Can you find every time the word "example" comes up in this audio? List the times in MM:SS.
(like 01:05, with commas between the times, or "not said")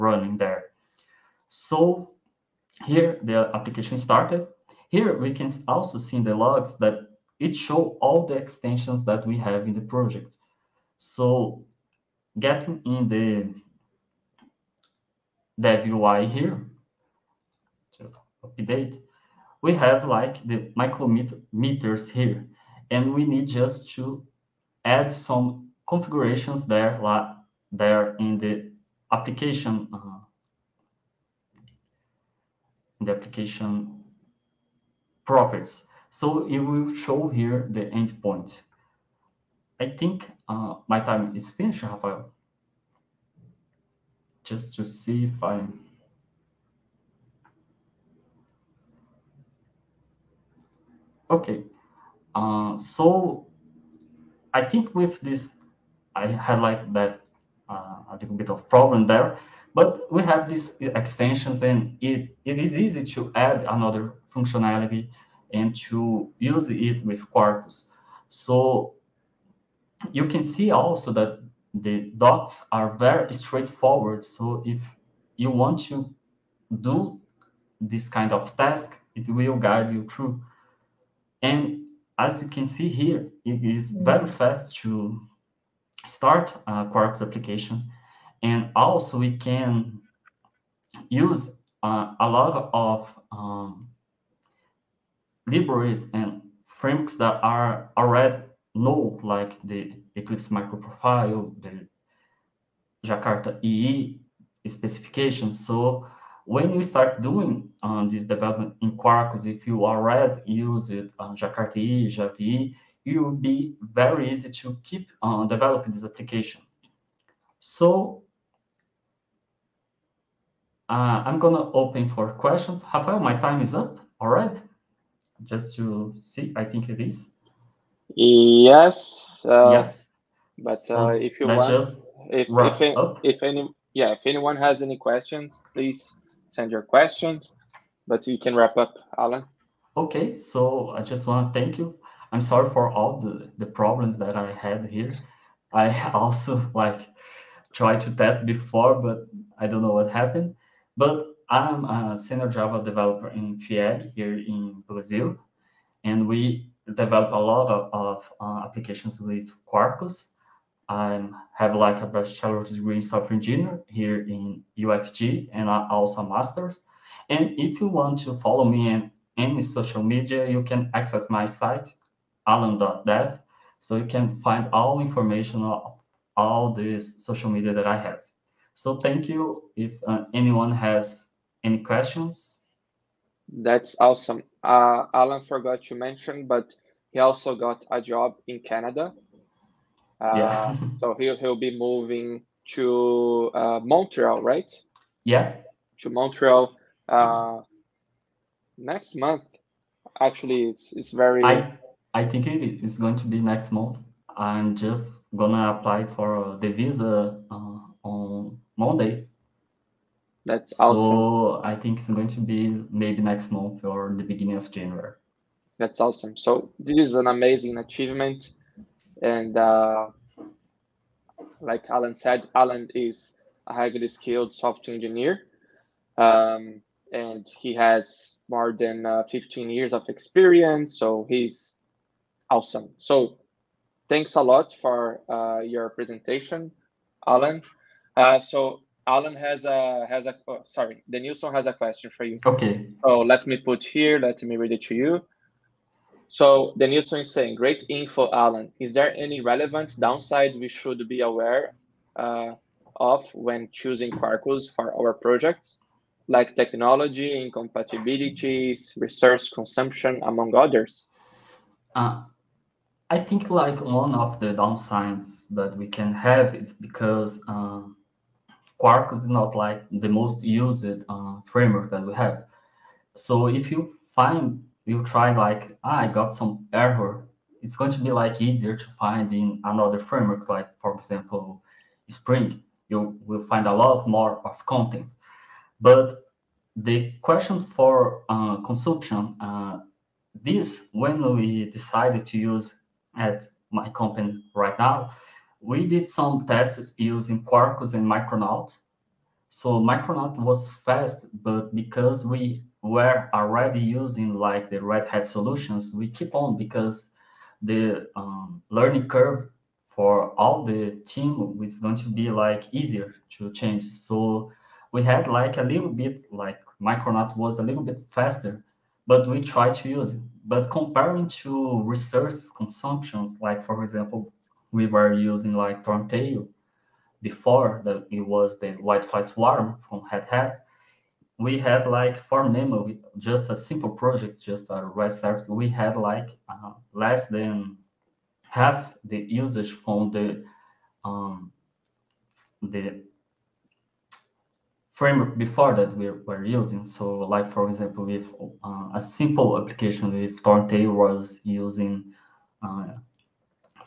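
04:40, 05:23, 05:47.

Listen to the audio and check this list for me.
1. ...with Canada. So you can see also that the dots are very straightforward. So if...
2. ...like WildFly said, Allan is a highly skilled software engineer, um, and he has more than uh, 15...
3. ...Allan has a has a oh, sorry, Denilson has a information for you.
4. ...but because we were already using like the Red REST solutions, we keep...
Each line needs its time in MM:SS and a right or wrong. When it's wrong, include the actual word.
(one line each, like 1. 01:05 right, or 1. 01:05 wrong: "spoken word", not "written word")
1. 01:07 wrong: "Quarkus", not "Canada"
2. 03:41 wrong: "Allan", not "WildFly"
3. 03:59 wrong: "question", not "information"
4. 05:01 wrong: "Hat", not "REST".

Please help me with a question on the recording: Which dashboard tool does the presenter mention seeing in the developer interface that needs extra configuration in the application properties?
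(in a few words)
micrometers.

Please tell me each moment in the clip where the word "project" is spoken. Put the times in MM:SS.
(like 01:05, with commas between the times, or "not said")
00:09, 04:15, 05:33.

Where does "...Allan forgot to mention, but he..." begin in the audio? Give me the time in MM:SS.
03:05.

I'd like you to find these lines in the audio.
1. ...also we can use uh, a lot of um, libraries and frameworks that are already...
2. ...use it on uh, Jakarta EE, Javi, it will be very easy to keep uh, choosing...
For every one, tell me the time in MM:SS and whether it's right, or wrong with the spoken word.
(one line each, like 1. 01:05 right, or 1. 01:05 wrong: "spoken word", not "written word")
1. 01:28 right
2. 01:50 wrong: "developing", not "choosing".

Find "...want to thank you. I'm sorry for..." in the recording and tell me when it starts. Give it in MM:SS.
02:21.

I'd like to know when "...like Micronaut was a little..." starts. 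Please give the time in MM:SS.
05:16.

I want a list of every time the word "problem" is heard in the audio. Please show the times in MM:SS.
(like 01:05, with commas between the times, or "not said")
00:58, 02:23.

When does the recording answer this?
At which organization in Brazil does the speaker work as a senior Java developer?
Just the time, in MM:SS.
02:33.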